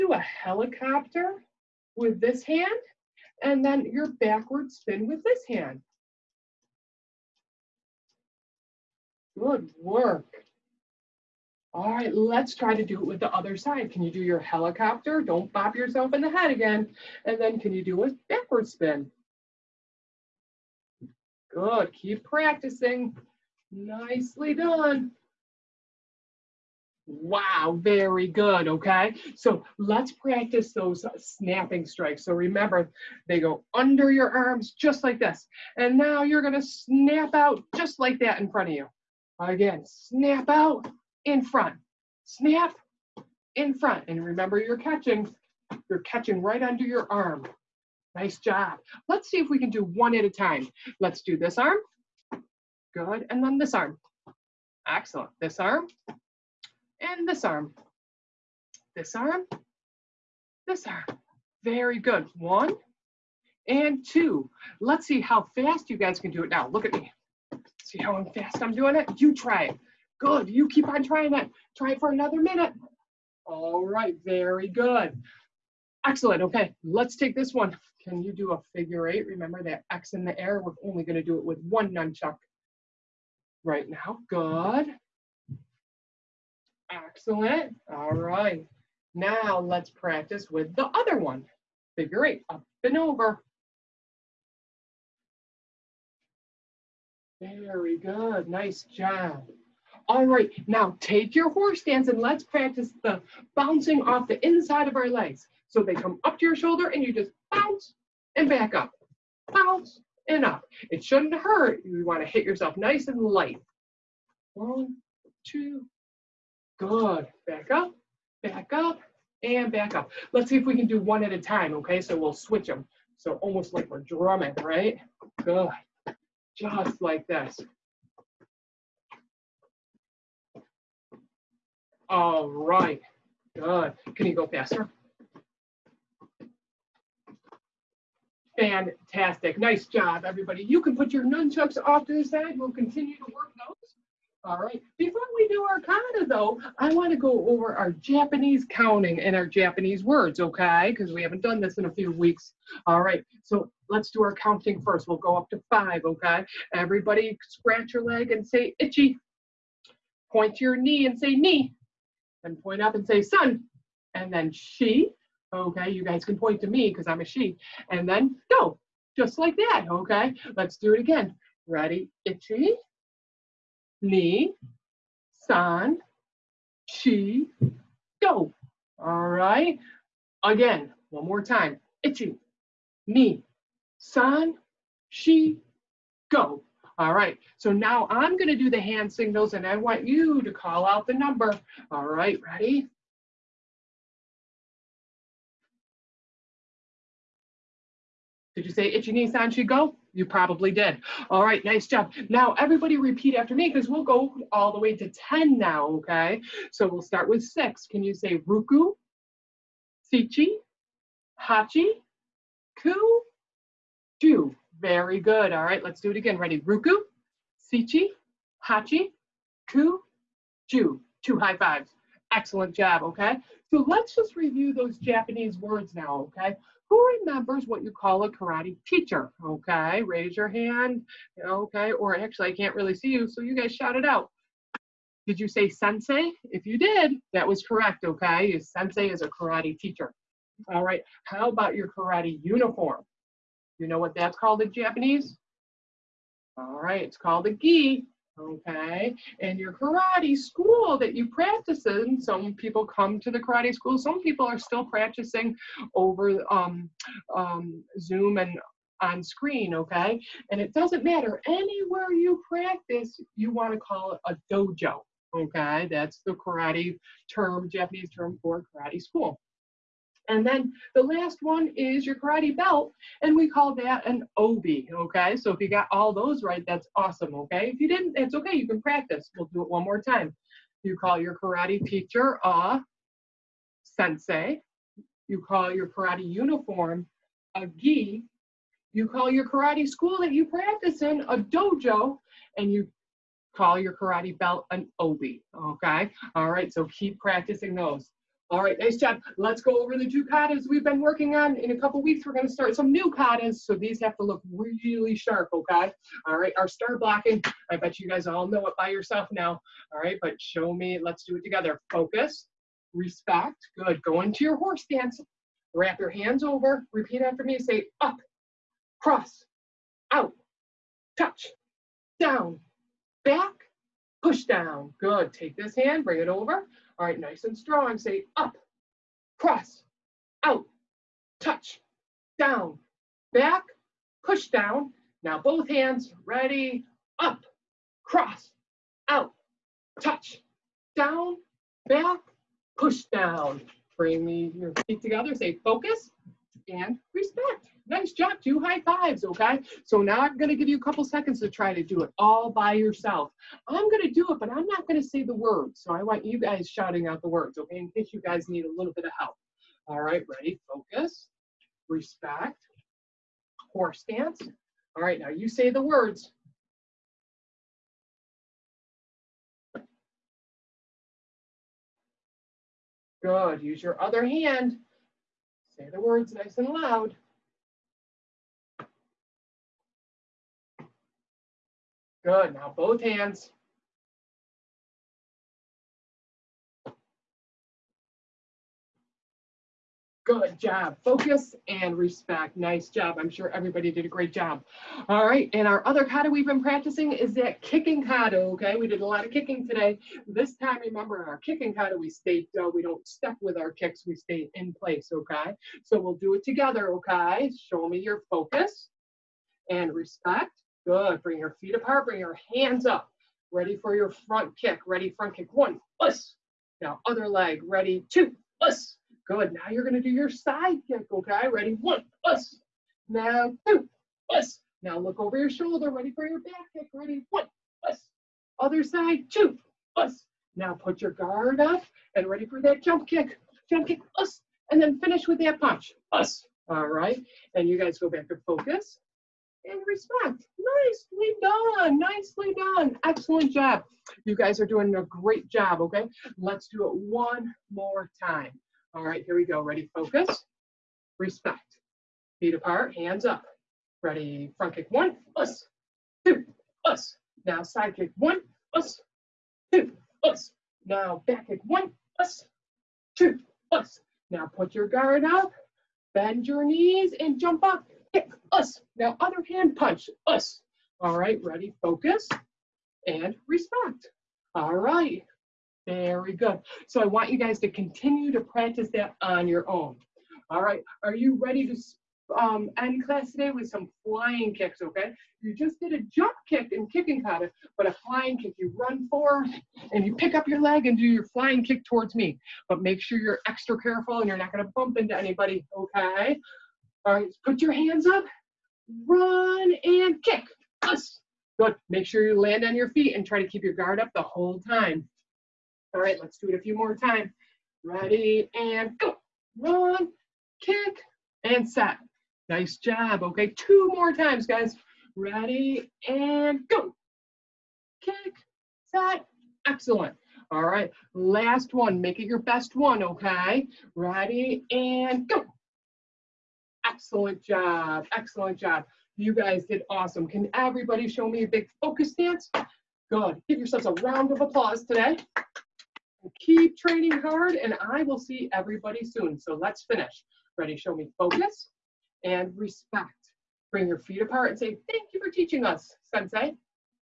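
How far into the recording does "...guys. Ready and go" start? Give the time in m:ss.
8:34.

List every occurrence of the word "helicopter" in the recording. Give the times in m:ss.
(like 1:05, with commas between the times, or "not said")
0:00, 0:14.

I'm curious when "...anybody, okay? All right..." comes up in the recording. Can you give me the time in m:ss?
8:15.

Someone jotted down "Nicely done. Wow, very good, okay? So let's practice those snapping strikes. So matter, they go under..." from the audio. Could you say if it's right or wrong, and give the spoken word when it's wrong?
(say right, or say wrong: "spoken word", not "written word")
wrong: "remember", not "matter".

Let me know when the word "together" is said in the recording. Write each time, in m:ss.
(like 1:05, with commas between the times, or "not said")
5:11, 5:45, 6:46.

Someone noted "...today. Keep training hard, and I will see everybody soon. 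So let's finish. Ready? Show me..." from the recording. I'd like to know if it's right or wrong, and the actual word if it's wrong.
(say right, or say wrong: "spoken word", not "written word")
right.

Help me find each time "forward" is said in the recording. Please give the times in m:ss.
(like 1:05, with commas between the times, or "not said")
8:09.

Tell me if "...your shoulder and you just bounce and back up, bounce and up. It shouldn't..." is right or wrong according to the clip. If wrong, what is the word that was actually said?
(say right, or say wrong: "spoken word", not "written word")
right.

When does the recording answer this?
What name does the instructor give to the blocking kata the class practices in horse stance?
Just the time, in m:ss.
5:06.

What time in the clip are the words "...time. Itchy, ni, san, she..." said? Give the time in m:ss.
3:01.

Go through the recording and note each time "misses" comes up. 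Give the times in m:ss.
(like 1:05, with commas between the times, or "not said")
not said.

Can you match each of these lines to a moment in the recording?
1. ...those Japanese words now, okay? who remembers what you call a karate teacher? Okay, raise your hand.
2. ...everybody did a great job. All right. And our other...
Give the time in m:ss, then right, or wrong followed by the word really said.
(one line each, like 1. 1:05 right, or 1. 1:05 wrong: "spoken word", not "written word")
1. 3:44 right
2. 6:33 right.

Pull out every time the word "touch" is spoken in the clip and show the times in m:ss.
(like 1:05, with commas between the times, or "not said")
5:21, 5:31, 5:39.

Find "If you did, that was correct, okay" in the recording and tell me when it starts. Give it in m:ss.
3:56.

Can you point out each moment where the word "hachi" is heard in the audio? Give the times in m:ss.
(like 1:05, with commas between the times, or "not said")
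3:31, 3:38.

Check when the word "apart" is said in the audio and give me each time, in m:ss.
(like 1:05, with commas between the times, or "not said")
6:51, 7:32, 9:04.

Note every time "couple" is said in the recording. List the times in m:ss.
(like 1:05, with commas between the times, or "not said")
5:01, 5:50.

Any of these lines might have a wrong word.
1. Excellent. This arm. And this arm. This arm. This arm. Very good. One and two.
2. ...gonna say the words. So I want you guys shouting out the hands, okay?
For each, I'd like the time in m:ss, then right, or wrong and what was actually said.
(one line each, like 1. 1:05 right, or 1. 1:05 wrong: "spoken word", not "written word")
1. 0:54 right
2. 5:54 wrong: "words", not "hands".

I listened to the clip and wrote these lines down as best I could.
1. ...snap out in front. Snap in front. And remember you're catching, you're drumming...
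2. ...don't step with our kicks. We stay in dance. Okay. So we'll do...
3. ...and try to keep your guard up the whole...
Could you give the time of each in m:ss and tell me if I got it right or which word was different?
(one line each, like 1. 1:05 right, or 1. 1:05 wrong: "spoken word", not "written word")
1. 0:39 wrong: "catching", not "drumming"
2. 6:42 wrong: "place", not "dance"
3. 8:23 right.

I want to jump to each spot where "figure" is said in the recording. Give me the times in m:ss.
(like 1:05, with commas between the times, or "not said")
1:18, 1:31.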